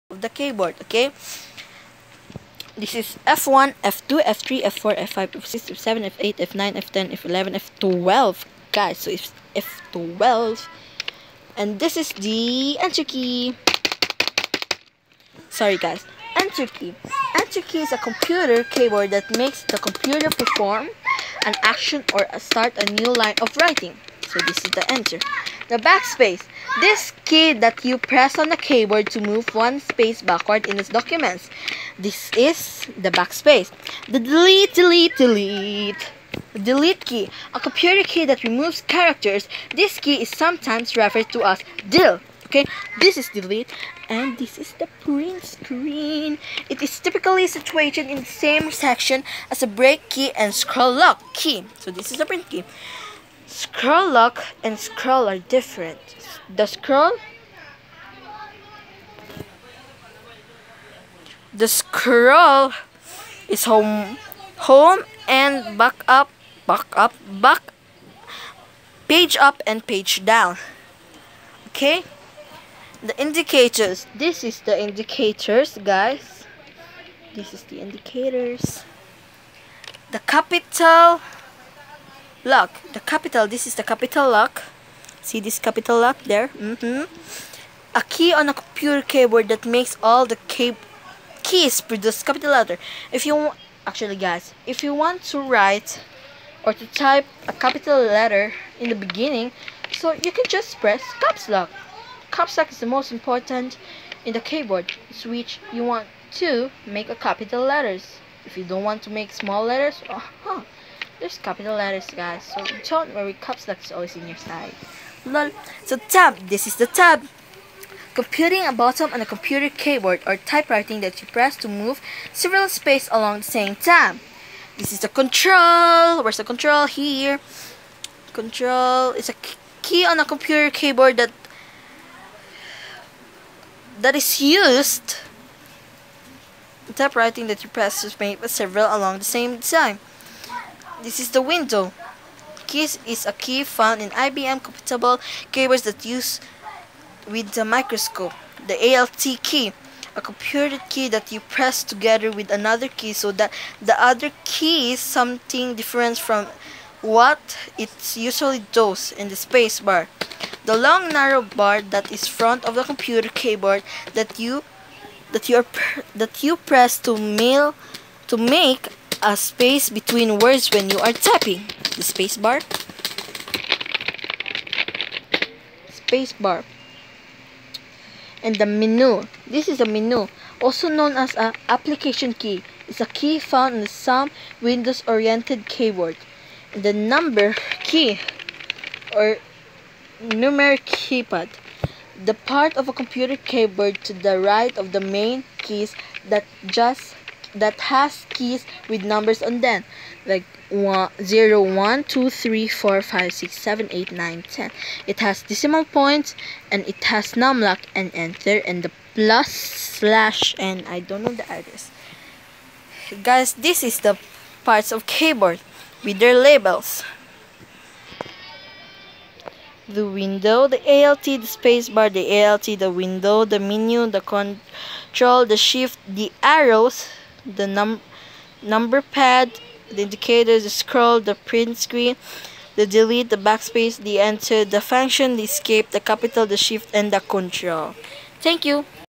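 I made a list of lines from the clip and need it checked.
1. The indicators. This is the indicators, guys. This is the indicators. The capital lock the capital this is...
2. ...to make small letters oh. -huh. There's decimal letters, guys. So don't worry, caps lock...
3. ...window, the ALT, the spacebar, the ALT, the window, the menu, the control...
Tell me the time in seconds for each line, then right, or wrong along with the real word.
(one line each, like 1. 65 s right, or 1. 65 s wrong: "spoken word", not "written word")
1. 73 s right
2. 109 s wrong: "capital", not "decimal"
3. 220 s right.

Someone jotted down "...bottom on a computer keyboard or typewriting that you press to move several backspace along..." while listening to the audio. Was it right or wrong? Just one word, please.
wrong.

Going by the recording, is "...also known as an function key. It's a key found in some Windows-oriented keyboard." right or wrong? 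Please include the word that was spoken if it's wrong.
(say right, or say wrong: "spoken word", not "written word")
wrong: "application", not "function".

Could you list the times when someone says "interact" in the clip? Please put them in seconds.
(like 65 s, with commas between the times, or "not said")
not said.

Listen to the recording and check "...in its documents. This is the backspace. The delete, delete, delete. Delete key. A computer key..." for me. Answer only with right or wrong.
right.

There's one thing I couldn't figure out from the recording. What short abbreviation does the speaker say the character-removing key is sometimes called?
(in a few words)
DIL.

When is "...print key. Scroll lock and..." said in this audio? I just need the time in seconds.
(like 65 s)
52 s.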